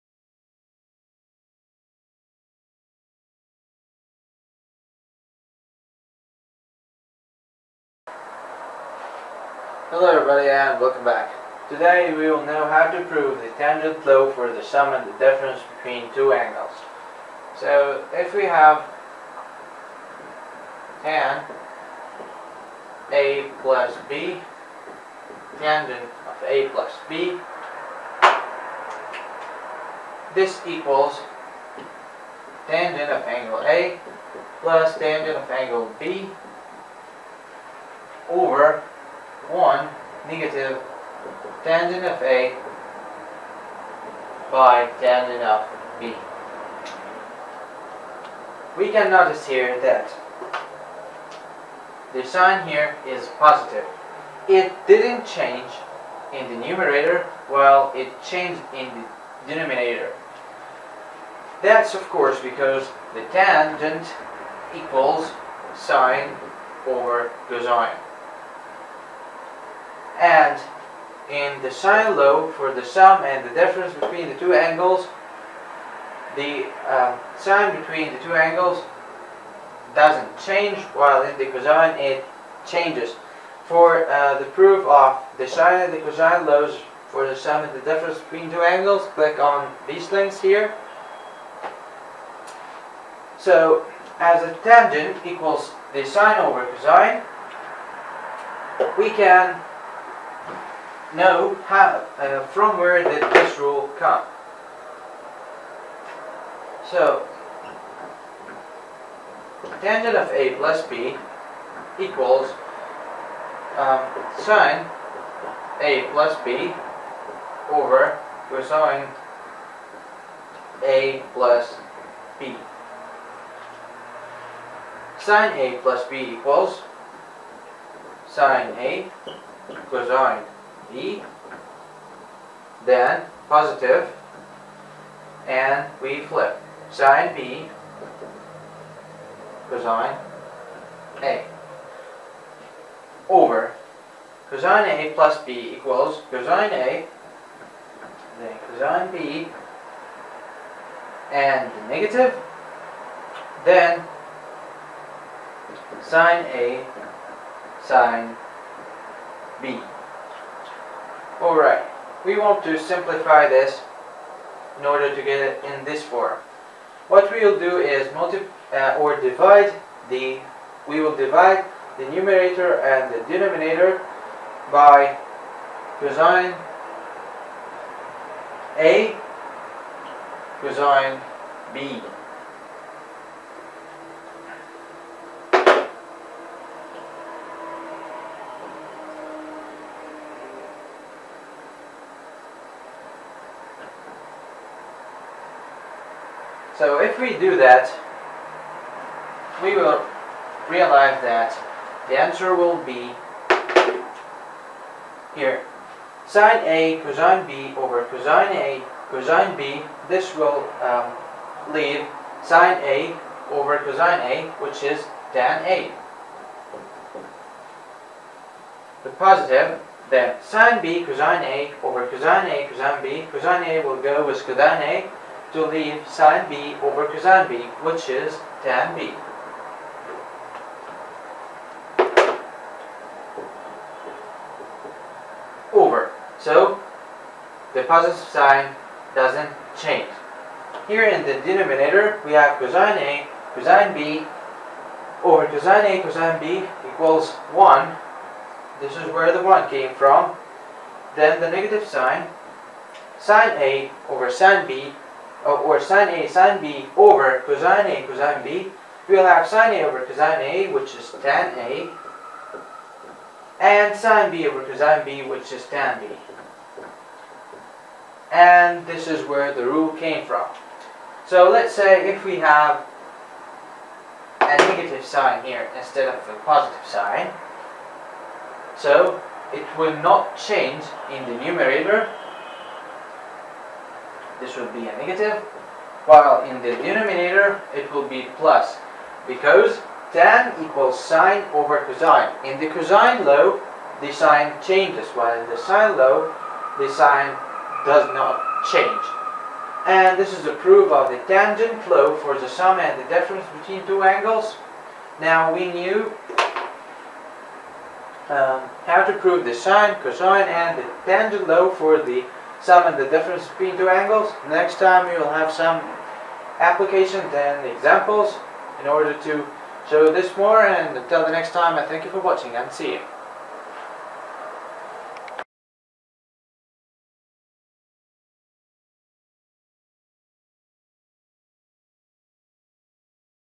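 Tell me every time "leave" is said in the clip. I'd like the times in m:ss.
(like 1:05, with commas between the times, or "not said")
3:31, 3:45.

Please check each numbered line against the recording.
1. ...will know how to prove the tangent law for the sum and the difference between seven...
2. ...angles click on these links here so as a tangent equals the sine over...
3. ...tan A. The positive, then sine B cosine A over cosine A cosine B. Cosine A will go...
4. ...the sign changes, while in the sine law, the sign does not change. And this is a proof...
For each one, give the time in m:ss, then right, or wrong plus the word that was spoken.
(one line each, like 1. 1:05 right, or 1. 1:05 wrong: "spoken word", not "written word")
1. 0:12 wrong: "two", not "seven"
2. 1:28 right
3. 3:35 right
4. 4:54 right.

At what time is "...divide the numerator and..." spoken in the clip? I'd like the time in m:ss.
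2:51.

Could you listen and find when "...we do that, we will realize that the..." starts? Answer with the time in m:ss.
3:17.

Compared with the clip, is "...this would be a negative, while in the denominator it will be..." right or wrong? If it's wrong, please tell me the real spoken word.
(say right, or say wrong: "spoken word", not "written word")
right.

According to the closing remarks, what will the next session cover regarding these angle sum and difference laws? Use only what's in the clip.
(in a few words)
applications and examples.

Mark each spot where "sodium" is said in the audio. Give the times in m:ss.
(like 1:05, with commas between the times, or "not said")
not said.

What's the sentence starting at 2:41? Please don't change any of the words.
Alright, we want to simplify this in order to get it in this form.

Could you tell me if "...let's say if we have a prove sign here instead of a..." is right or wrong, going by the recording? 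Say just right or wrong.
wrong.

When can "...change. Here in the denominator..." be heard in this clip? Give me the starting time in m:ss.
3:59.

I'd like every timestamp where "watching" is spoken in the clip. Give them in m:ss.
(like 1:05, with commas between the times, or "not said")
5:22.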